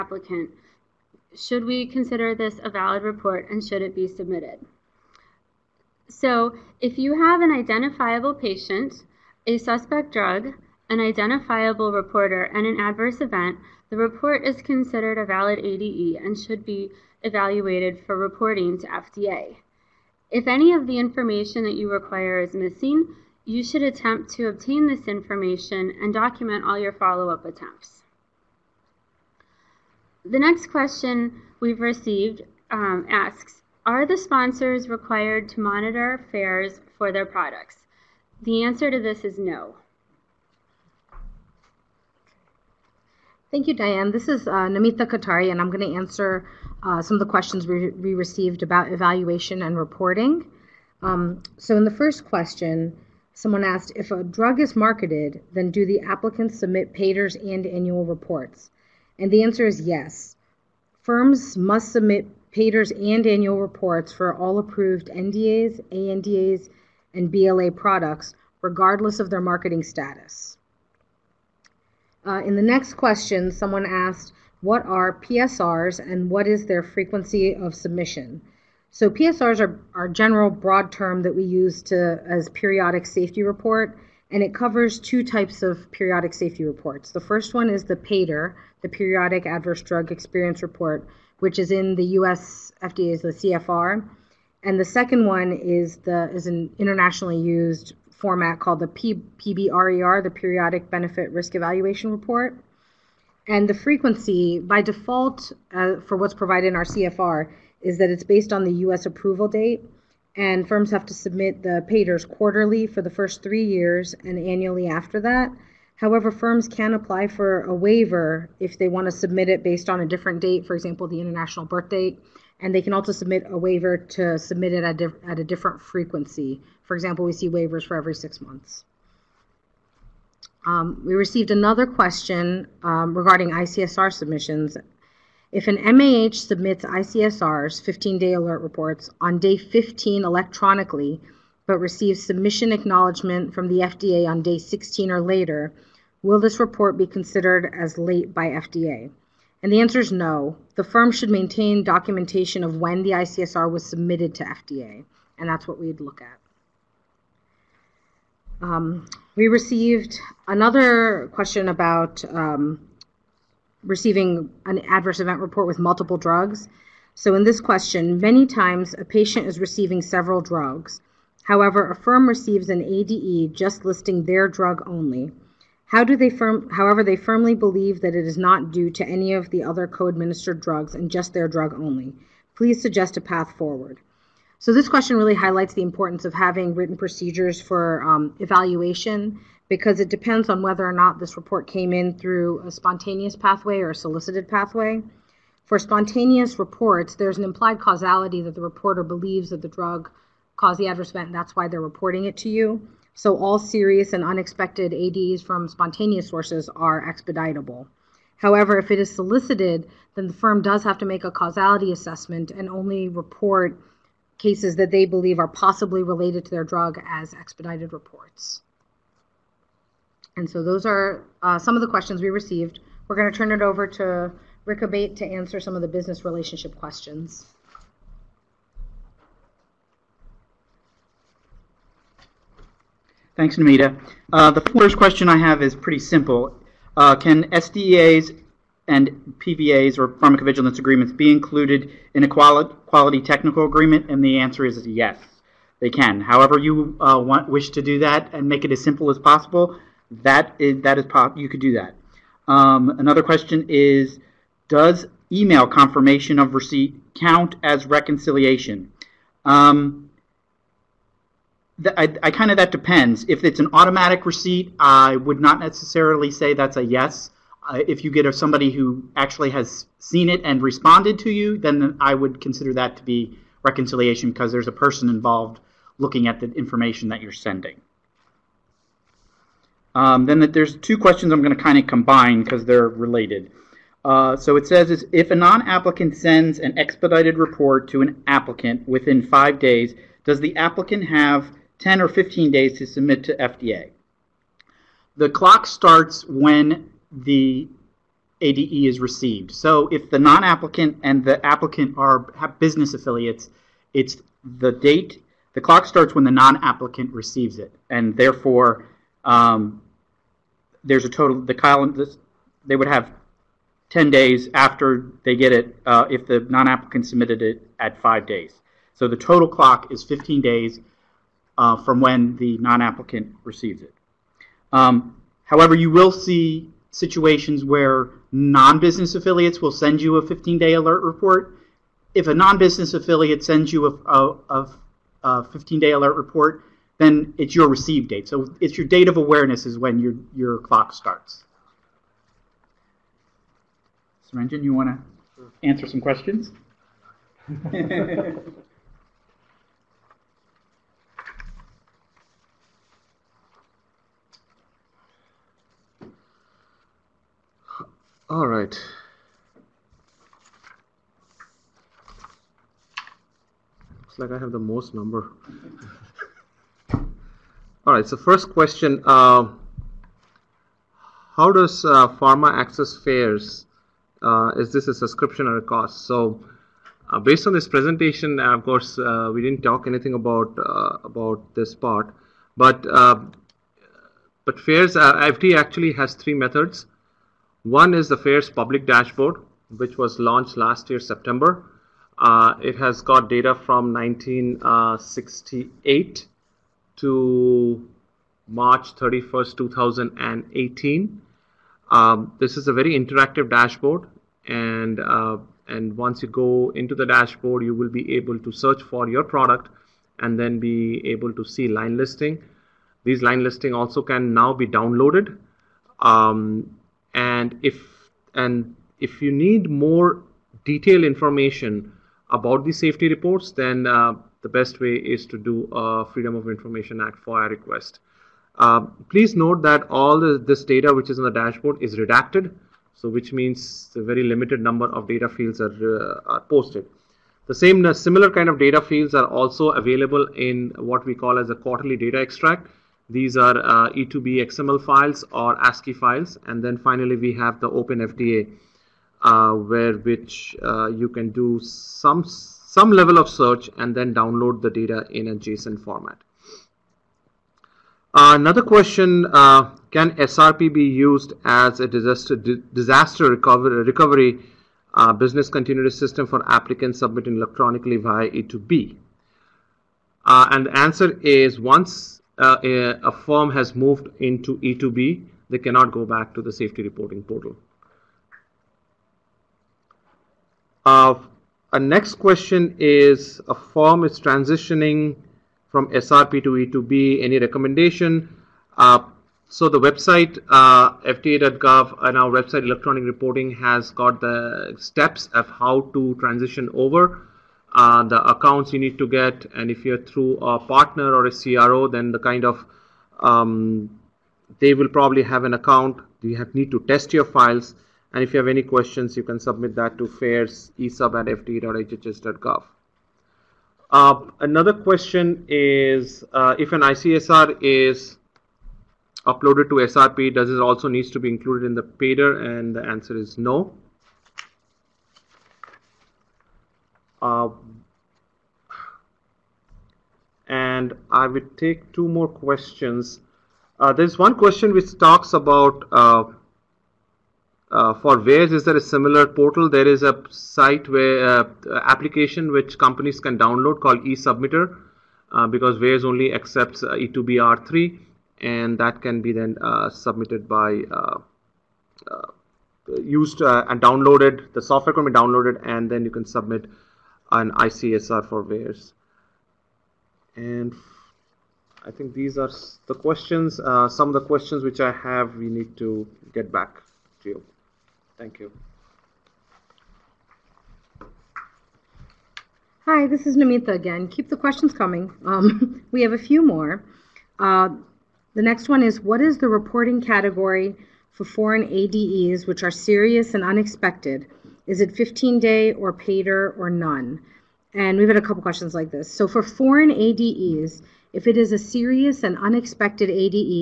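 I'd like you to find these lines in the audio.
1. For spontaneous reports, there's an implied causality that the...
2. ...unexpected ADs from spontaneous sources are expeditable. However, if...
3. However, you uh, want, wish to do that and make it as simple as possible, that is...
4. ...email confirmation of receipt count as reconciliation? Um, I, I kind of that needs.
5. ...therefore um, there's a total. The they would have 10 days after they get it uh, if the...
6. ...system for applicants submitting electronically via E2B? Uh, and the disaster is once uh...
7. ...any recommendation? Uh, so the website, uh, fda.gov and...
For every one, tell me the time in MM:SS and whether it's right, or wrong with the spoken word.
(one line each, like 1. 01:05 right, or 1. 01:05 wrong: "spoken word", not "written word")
1. 03:15 right
2. 03:24 right
3. 04:06 right
4. 04:15 wrong: "depends", not "needs"
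5. 05:08 right
6. 07:45 wrong: "answer", not "disaster"
7. 08:07 right.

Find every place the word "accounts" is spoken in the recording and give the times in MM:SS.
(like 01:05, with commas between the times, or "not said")
08:18, 08:25.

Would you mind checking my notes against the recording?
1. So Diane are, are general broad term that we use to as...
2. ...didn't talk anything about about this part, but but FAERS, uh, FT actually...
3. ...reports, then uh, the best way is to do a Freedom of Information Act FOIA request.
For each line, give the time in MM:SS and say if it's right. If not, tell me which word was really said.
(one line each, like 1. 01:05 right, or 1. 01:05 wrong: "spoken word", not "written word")
1. 01:18 wrong: "PSRs", not "Diane"
2. 06:19 right
3. 07:03 right.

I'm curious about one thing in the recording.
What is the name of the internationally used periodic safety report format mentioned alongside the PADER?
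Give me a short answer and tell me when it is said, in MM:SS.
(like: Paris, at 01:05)
Periodic Benefit Risk Evaluation Report, at 01:40.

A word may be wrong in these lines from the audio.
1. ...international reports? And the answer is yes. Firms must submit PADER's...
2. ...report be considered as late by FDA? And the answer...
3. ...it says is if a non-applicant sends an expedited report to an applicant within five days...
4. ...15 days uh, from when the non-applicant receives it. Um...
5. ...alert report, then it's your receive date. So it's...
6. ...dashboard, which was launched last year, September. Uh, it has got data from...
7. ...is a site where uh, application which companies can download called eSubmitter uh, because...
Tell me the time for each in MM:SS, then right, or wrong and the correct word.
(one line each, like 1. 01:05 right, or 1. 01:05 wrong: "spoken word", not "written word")
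1. 00:57 wrong: "annual", not "international"
2. 02:26 right
3. 04:44 right
4. 05:20 right
5. 05:35 right
6. 06:28 right
7. 08:59 right.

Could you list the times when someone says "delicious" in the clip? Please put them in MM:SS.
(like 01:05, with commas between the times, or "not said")
not said.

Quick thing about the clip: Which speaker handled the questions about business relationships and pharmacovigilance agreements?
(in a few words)
Rick Abate.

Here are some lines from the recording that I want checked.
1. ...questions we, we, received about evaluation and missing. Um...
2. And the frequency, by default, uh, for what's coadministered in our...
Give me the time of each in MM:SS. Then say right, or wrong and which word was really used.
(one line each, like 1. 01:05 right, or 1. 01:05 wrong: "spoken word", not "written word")
1. 00:47 wrong: "reporting", not "missing"
2. 01:43 wrong: "provided", not "coadministered".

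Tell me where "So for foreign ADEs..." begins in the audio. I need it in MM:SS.
09:49.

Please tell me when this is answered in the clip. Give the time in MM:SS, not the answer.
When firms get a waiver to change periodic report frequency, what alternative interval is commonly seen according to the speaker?
02:07.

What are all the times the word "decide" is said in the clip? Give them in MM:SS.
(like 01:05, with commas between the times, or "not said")
not said.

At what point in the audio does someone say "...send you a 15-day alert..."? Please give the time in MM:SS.
05:29.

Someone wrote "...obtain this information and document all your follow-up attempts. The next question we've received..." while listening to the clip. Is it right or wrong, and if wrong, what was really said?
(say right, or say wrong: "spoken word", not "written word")
right.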